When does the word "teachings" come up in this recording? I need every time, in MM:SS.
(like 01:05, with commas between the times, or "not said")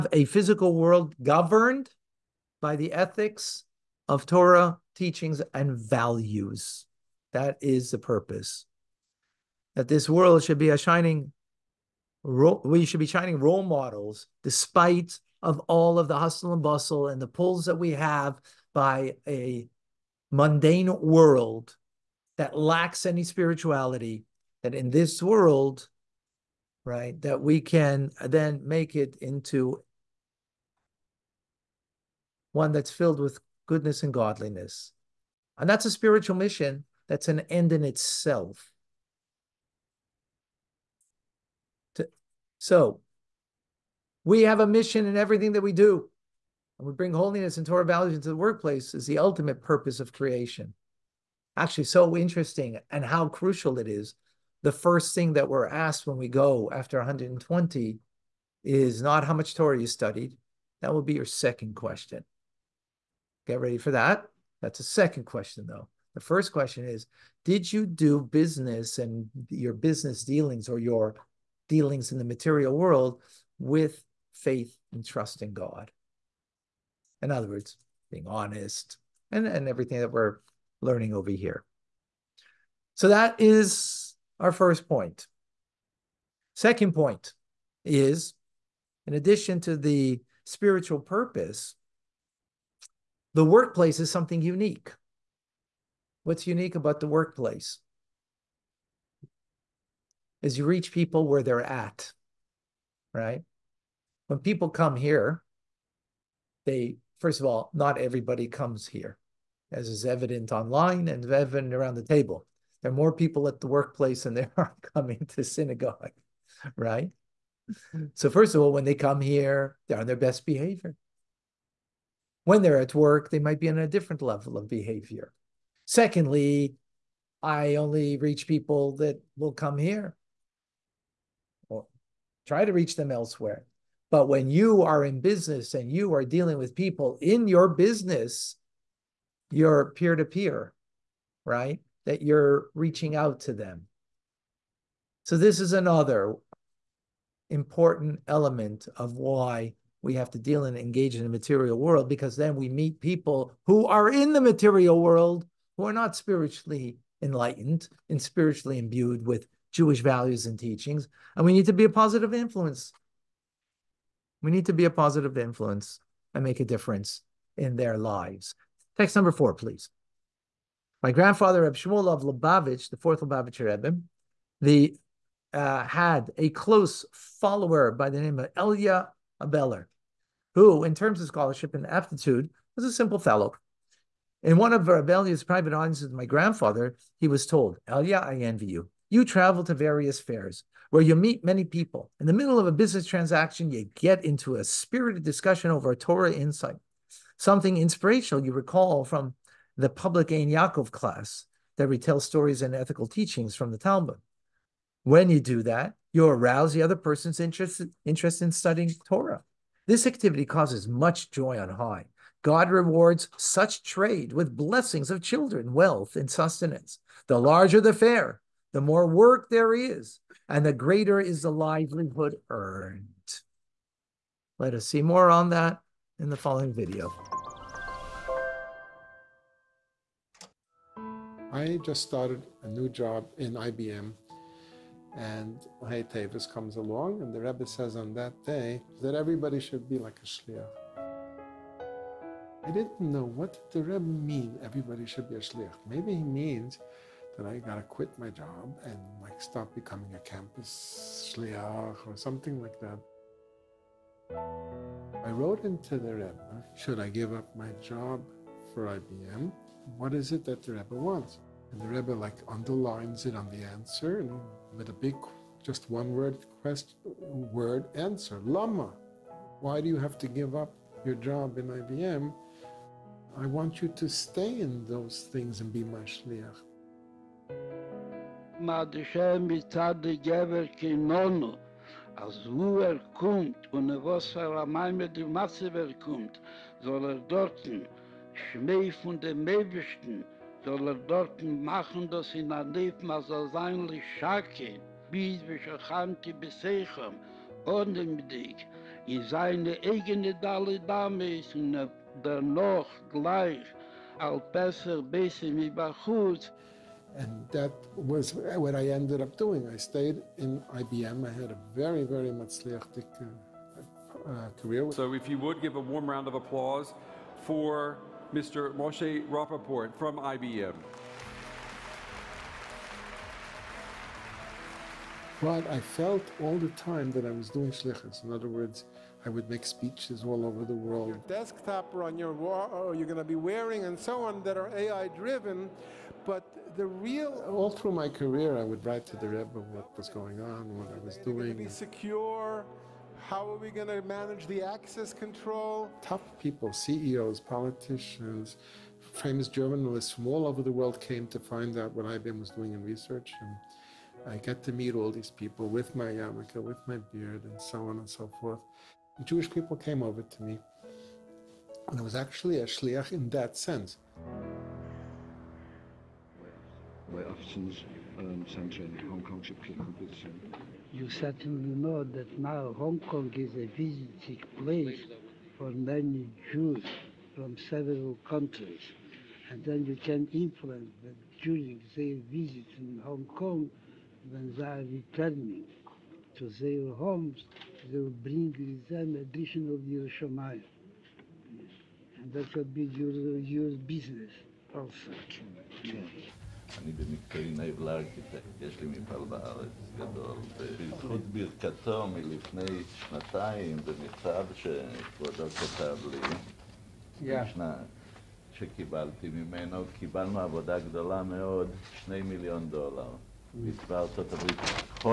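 00:04, 02:40, 03:23.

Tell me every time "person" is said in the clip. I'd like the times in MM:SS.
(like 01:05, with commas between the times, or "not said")
03:26.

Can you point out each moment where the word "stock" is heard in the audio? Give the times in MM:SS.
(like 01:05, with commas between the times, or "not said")
not said.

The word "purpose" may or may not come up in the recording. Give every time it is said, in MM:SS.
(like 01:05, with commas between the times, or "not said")
00:07, 00:49, 01:30.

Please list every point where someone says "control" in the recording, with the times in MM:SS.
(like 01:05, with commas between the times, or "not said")
05:45.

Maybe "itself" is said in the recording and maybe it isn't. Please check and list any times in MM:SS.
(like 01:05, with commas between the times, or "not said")
00:37.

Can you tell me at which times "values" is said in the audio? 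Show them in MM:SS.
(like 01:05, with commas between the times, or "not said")
00:05, 00:47, 02:40.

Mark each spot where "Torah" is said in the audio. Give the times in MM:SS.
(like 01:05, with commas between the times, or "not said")
00:04, 00:47, 00:59, 03:15, 03:29.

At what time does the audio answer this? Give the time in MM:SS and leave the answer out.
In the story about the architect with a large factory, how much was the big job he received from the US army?
06:51.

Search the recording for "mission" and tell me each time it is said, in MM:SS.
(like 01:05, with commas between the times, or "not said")
00:36, 00:44.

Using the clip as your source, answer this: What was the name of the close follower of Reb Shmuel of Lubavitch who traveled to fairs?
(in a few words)
Elia Abeller.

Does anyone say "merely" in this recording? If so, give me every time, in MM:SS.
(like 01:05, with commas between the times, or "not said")
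not said.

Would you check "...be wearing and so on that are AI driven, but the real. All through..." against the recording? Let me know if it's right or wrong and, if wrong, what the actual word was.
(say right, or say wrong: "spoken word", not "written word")
right.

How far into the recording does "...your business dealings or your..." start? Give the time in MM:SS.
01:09.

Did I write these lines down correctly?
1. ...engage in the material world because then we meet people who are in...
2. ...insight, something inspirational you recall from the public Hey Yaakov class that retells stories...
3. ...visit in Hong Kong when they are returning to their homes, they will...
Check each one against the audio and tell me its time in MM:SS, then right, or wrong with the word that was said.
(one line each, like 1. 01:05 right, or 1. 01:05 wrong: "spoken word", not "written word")
1. 02:30 right
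2. 03:16 wrong: "Ein", not "Hey"
3. 06:22 right.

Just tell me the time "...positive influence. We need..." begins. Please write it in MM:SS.
02:41.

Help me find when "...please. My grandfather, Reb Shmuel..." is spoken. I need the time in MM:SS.
02:49.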